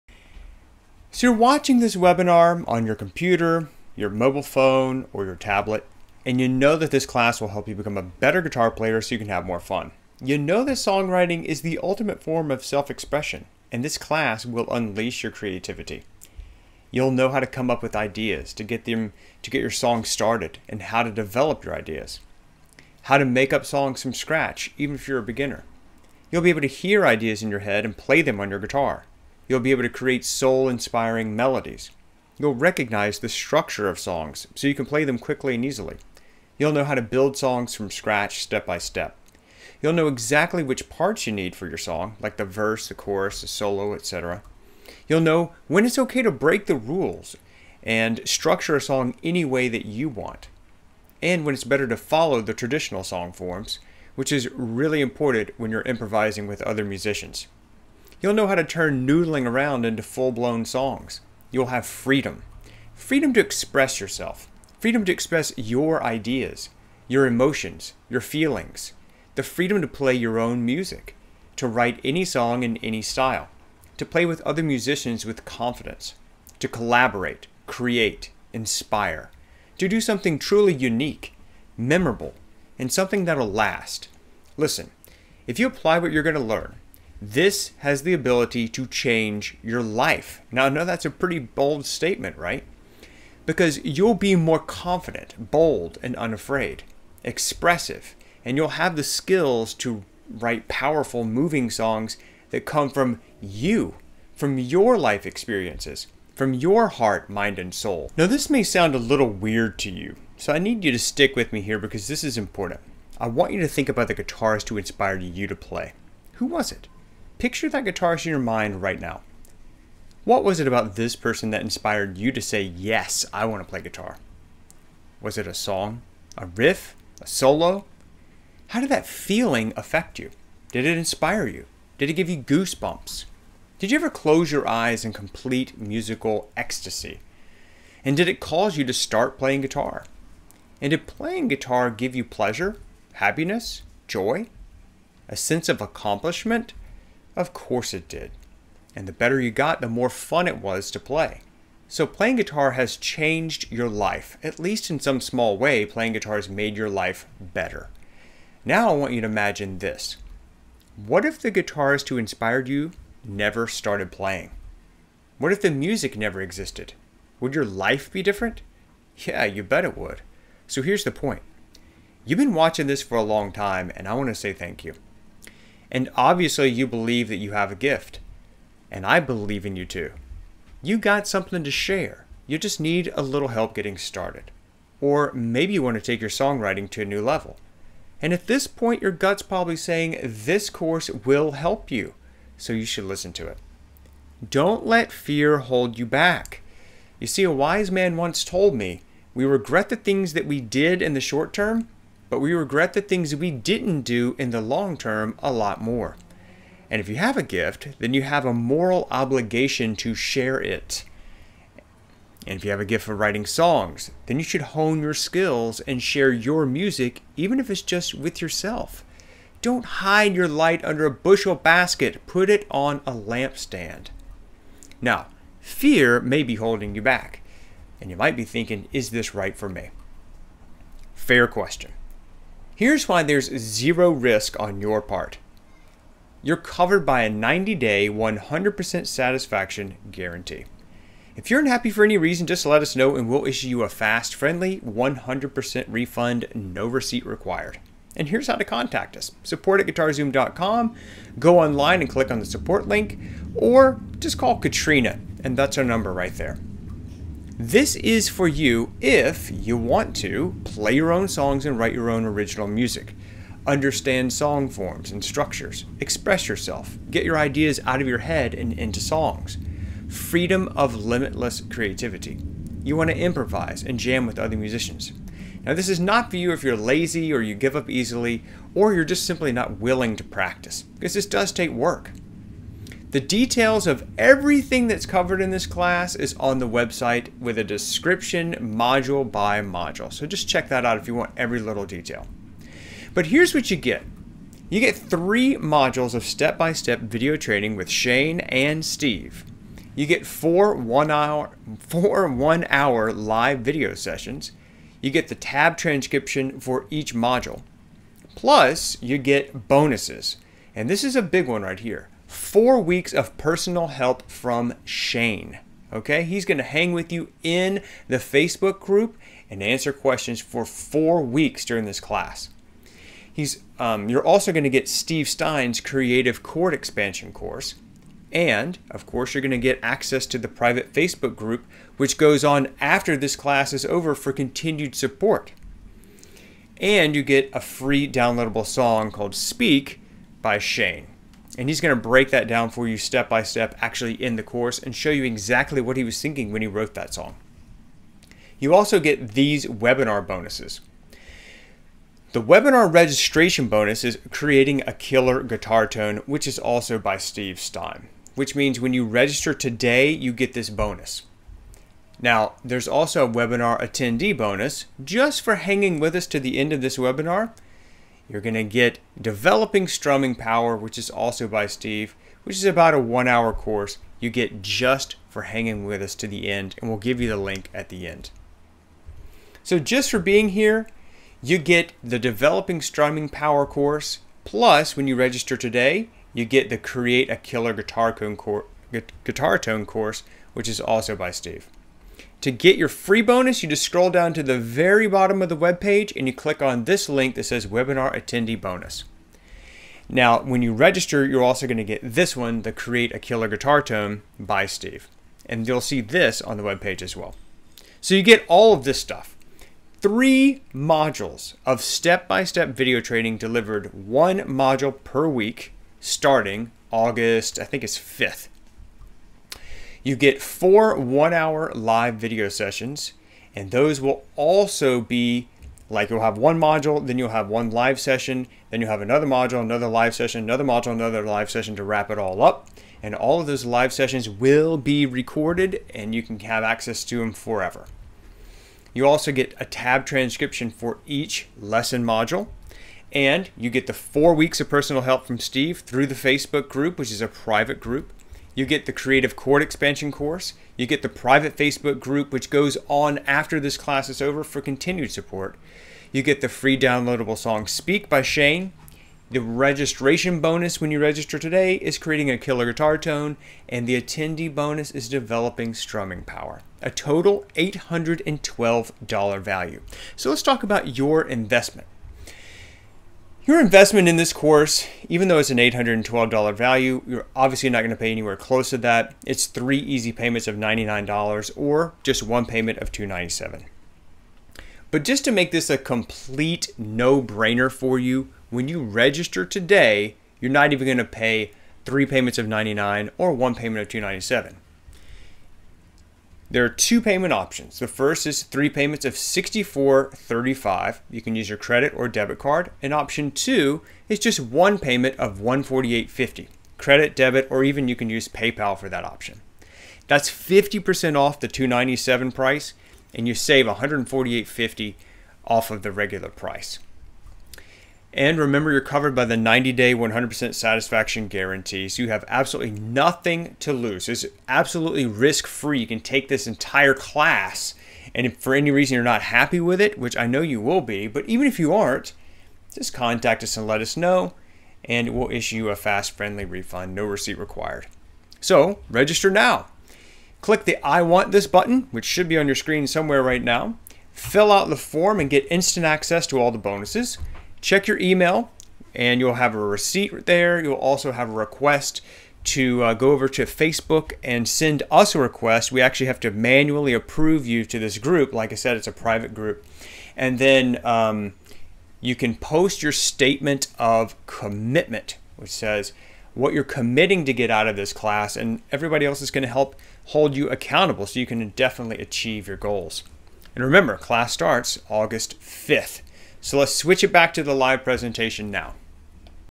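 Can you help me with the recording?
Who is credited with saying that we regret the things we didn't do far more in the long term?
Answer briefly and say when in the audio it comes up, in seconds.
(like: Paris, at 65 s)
a wise man, at 197 s.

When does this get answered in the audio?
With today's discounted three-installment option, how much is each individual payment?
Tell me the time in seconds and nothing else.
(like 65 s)
499 s.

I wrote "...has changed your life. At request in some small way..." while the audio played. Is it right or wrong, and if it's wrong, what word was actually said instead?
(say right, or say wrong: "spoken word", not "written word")
wrong: "least", not "request".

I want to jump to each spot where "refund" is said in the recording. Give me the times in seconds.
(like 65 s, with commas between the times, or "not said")
245 s, 536 s.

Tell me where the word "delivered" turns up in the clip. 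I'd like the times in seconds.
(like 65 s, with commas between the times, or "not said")
413 s.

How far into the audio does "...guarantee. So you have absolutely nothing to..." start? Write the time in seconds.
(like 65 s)
521 s.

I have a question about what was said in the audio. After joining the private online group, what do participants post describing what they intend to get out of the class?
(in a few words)
statement of commitment.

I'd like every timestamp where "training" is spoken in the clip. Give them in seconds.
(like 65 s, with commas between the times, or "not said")
297 s, 413 s.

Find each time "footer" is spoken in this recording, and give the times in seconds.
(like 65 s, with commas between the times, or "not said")
not said.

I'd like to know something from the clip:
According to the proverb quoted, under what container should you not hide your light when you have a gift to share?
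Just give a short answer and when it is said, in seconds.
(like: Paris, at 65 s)
bushel basket, at 221 s.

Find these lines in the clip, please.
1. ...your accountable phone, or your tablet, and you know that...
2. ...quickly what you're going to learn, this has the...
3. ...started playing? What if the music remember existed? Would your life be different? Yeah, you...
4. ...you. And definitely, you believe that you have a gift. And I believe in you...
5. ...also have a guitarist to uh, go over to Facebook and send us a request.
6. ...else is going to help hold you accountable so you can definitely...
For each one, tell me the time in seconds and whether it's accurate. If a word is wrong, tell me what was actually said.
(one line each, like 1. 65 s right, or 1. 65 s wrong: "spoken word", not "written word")
1. 3 s wrong: "mobile", not "accountable"
2. 85 s wrong: "apply", not "quickly"
3. 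163 s wrong: "never", not "remember"
4. 174 s wrong: "obviously", not "definitely"
5. 550 s wrong: "request", not "guitarist"
6. 569 s right.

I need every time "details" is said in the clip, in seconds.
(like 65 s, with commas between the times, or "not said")
283 s, 291 s.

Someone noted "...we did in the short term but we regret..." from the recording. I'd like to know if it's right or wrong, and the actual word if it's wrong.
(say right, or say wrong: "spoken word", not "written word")
right.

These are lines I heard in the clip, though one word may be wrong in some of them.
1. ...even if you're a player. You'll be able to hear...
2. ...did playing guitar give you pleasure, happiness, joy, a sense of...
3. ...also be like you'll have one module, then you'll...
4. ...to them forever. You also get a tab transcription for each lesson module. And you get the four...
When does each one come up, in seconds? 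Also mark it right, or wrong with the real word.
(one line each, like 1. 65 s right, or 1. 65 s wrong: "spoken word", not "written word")
1. 24 s wrong: "beginner", not "player"
2. 140 s right
3. 424 s right
4. 437 s right.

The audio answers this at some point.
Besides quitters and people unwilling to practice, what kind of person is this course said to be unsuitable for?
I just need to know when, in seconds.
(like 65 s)
276 s.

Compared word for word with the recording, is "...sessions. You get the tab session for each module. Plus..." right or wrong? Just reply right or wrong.
wrong.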